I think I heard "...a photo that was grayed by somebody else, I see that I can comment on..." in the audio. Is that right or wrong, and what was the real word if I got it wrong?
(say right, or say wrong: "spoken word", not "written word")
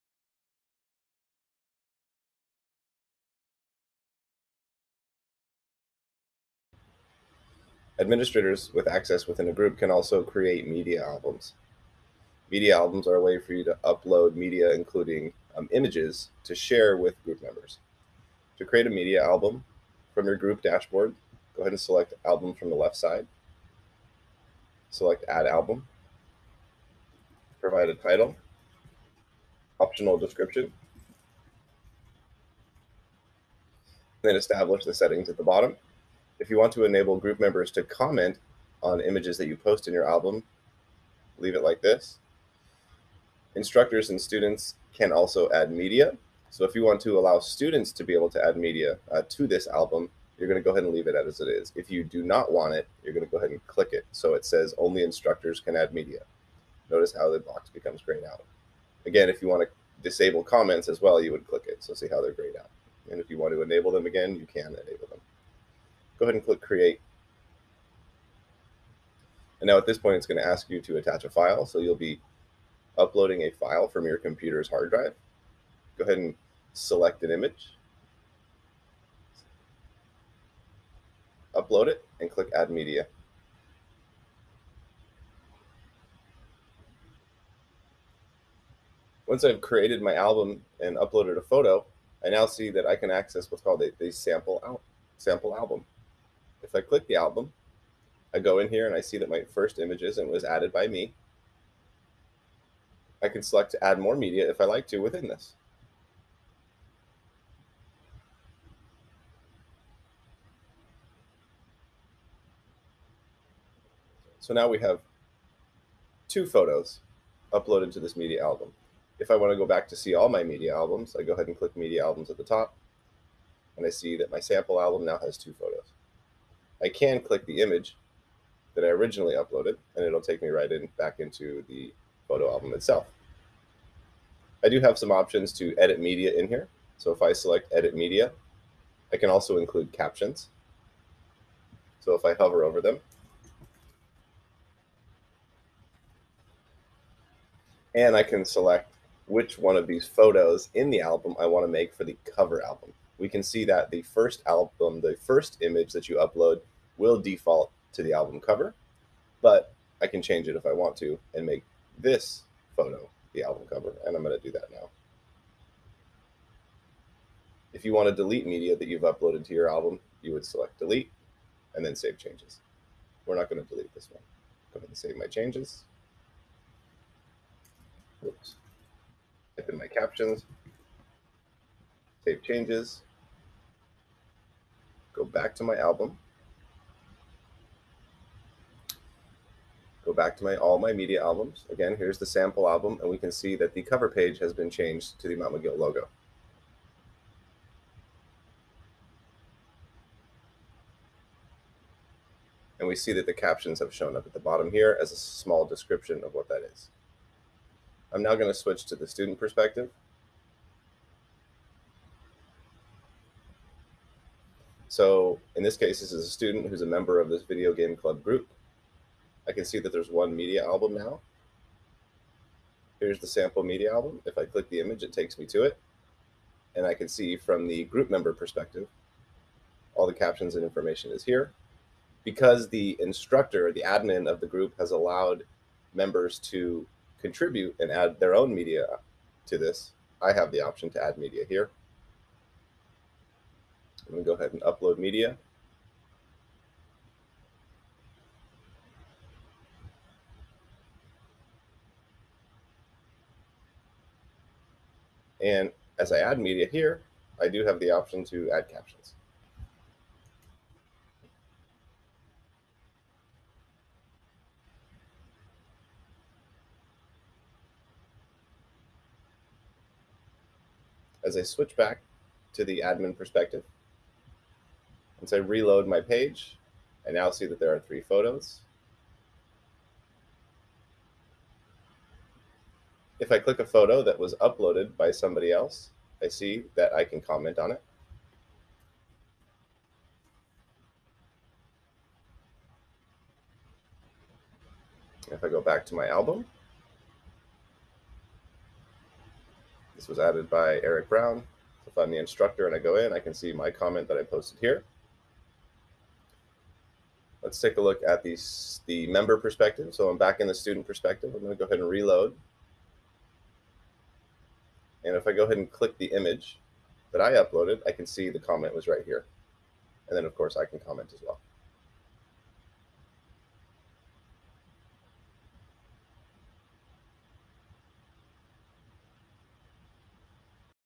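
wrong: "uploaded", not "grayed".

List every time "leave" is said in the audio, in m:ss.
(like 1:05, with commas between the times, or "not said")
0:41, 0:50.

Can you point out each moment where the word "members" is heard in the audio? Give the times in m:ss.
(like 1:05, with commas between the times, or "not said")
0:17, 0:37, 3:36, 3:48, 3:55, 5:09.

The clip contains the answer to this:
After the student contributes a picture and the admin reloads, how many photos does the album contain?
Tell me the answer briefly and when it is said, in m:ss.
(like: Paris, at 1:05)
3, at 4:37.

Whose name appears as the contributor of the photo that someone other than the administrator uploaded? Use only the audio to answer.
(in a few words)
Eric Brown.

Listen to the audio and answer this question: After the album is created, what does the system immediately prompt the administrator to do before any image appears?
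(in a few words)
Attach a file.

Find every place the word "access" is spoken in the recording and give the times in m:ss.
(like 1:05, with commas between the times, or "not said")
0:08, 1:33.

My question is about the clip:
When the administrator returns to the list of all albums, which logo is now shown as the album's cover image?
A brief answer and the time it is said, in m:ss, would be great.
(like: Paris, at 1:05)
Mount Miguel logo, at 3:15.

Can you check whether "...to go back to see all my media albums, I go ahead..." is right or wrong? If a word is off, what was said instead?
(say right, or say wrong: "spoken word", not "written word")
right.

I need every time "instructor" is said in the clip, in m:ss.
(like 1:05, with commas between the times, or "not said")
0:43, 0:55, 3:52, 5:02.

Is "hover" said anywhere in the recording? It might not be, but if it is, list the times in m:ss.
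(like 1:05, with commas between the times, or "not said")
2:22.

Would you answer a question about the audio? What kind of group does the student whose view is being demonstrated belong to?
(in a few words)
Video game club.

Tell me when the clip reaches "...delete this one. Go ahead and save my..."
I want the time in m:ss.
2:53.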